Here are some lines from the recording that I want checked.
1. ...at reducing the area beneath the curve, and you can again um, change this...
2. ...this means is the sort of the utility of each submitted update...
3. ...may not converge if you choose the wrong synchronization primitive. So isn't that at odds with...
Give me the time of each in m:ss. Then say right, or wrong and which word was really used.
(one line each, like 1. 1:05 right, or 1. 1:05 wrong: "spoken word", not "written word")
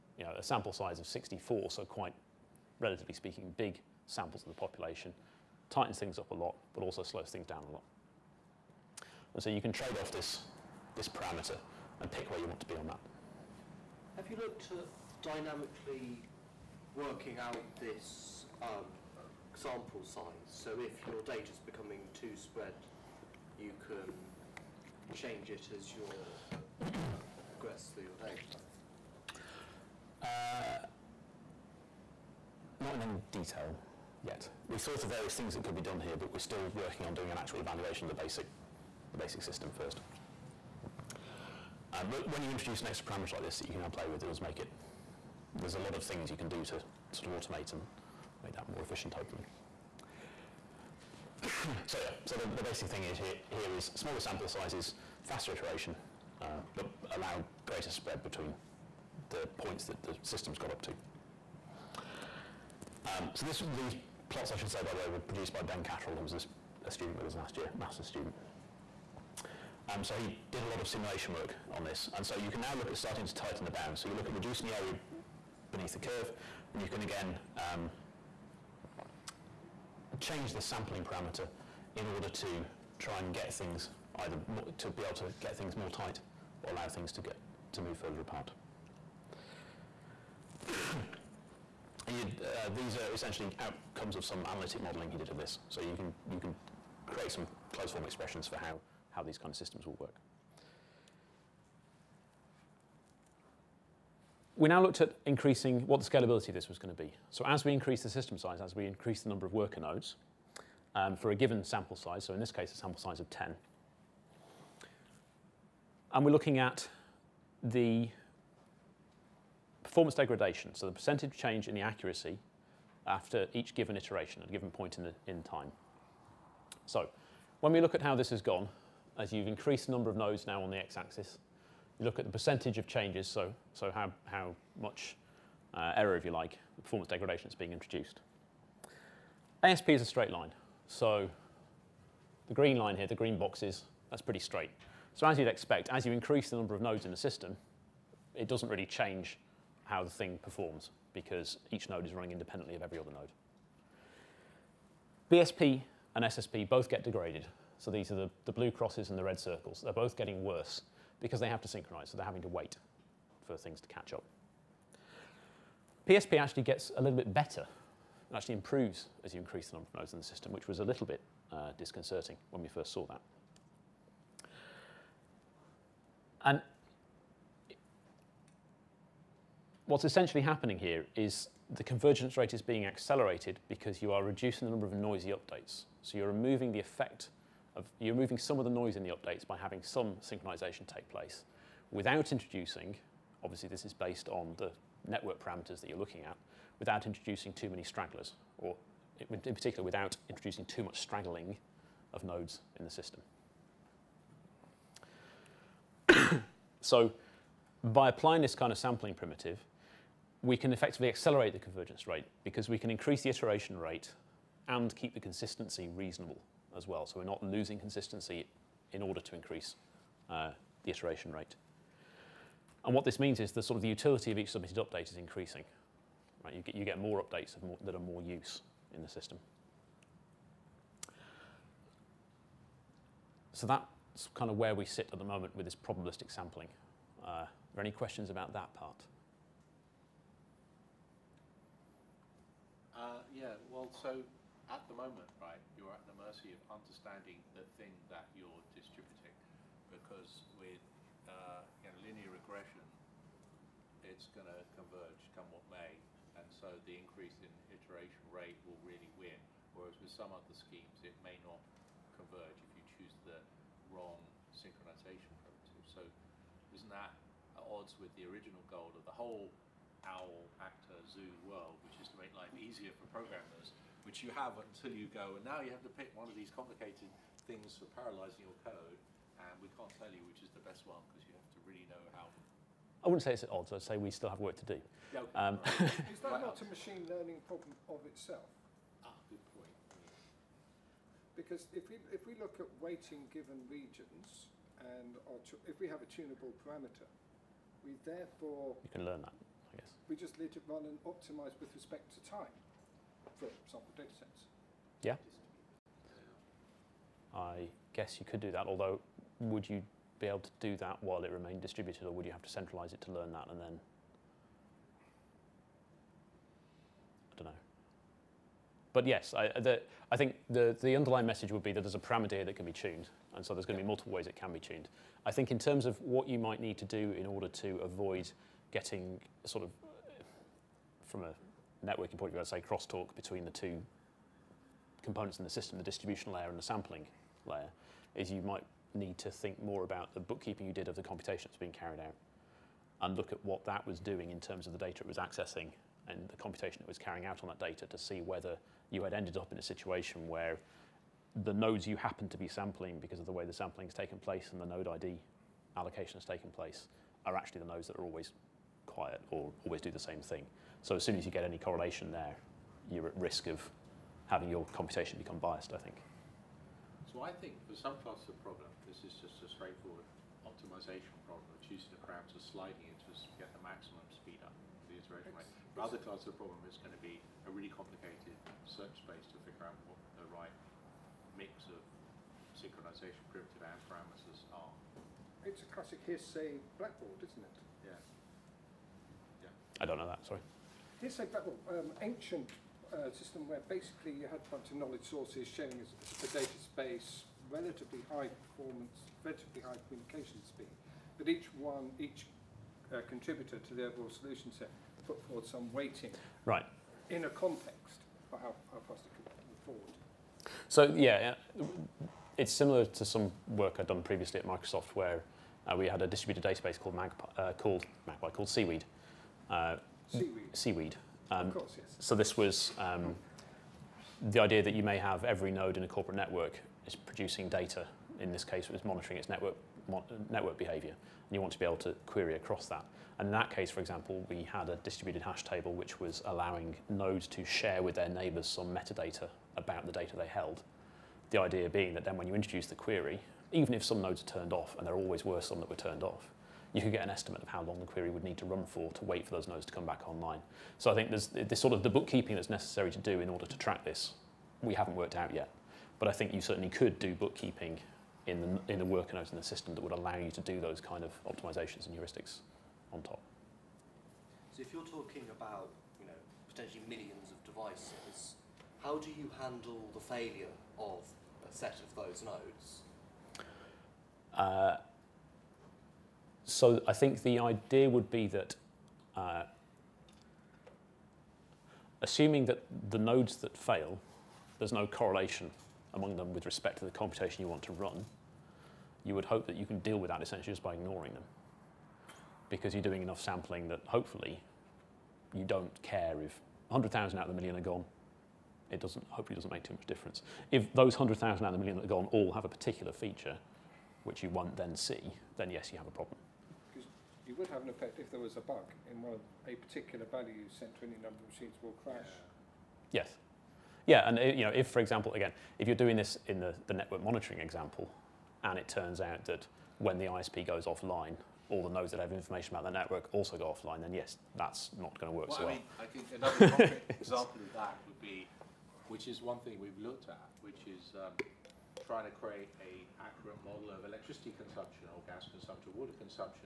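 1. 1:14 right
2. 3:43 right
3. 4:21 right.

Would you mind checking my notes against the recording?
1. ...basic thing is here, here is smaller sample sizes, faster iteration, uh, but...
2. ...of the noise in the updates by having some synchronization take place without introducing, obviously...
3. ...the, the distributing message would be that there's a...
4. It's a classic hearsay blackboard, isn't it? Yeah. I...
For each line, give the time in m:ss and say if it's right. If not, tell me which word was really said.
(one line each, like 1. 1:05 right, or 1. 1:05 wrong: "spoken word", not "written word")
1. 0:52 right
2. 3:08 right
3. 5:20 wrong: "underlying", not "distributing"
4. 6:25 right.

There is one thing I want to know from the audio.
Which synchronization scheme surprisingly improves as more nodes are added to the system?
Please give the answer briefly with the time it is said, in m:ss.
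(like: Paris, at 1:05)
PSP, at 2:46.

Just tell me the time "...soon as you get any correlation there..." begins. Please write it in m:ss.
6:01.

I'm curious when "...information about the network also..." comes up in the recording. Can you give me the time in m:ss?
8:42.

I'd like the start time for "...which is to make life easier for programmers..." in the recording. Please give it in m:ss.
4:31.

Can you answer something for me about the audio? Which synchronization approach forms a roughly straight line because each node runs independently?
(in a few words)
ASP.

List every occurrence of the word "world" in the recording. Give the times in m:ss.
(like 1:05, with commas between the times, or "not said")
4:31.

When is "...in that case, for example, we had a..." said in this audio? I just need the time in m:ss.
7:13.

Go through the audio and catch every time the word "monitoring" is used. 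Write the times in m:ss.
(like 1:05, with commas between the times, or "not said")
7:08, 8:37.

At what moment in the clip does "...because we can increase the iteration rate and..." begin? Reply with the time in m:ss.
3:32.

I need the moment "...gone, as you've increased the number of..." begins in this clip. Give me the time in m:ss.
2:08.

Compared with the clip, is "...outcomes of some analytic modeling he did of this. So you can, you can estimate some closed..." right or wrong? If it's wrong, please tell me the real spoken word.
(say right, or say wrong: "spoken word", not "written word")
wrong: "create", not "estimate".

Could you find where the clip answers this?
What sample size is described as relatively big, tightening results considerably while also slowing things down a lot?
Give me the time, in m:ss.
0:01.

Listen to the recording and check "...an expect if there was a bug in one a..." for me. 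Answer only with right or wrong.
wrong.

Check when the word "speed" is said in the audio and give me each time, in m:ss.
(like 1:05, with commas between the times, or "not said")
6:14, 6:40.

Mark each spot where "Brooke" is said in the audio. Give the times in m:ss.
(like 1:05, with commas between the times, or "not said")
not said.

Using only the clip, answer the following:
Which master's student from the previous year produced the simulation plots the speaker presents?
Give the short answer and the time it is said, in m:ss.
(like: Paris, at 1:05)
Ben Cattrell, at 1:05.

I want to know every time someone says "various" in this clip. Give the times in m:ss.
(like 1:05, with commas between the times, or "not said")
0:35.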